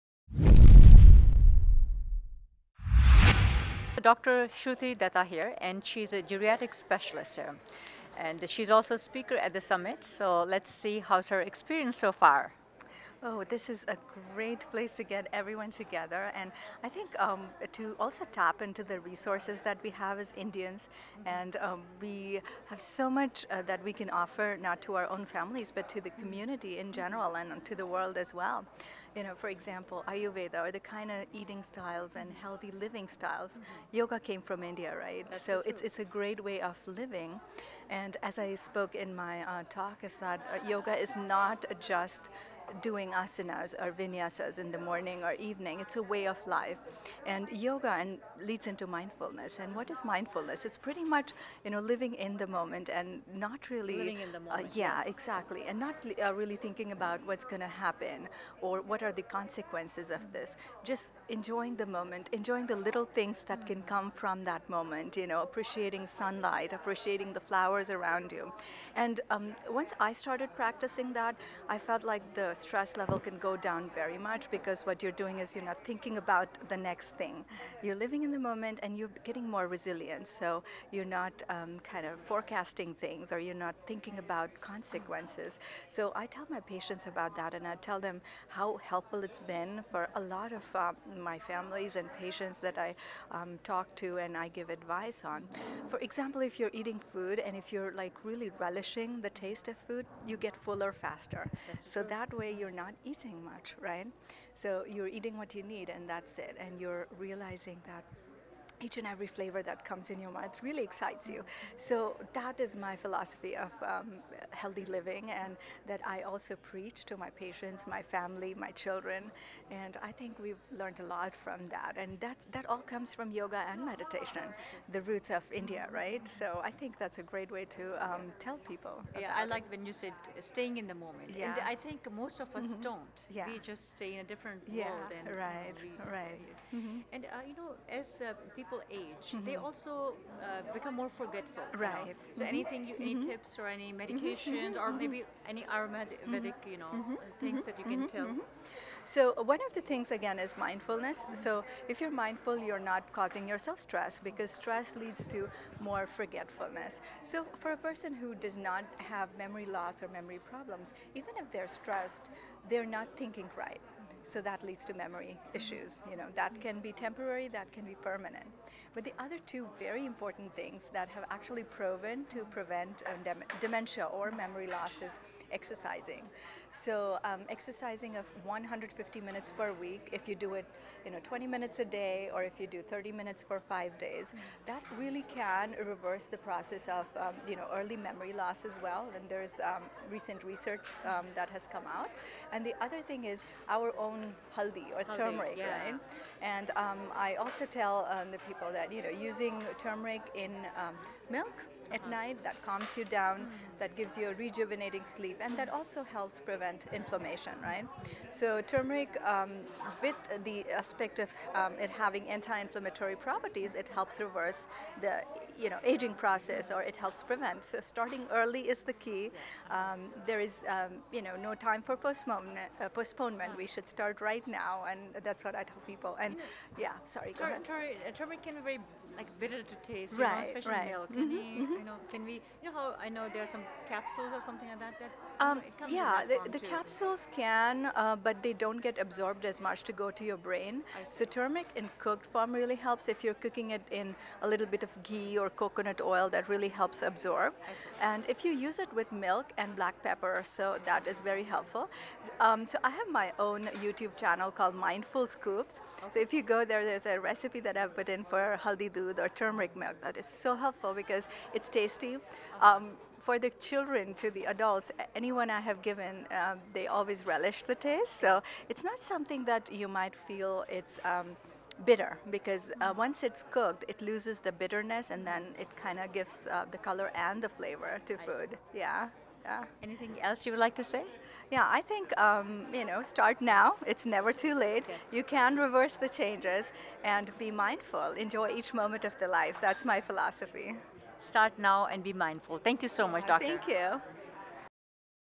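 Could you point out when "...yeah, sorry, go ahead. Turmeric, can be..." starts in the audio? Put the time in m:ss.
3:46.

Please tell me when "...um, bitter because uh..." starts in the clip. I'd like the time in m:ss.
4:31.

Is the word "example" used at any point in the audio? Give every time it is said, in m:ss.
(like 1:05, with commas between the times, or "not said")
0:29, 1:35.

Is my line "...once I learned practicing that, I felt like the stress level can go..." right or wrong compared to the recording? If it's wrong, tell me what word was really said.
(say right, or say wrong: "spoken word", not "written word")
wrong: "started", not "learned".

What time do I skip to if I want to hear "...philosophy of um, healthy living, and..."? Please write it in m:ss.
1:52.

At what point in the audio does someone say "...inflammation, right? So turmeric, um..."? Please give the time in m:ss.
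3:26.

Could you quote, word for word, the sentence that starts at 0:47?
And yoga and leads into mindfulness.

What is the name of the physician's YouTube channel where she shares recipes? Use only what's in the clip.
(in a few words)
Mindful Scoops.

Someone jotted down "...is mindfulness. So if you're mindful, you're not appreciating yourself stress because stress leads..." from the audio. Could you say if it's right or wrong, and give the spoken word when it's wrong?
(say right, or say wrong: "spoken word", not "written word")
wrong: "causing", not "appreciating".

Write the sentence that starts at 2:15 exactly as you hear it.
Yeah, right, you know, we, right.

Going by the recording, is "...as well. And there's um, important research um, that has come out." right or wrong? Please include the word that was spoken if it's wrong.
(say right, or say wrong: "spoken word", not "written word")
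wrong: "recent", not "important".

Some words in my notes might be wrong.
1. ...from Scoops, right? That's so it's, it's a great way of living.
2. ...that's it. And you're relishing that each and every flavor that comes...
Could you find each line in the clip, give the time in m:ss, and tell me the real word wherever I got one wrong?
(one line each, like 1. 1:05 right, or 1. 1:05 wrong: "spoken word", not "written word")
1. 0:34 wrong: "India", not "Scoops"
2. 1:46 wrong: "realizing", not "relishing".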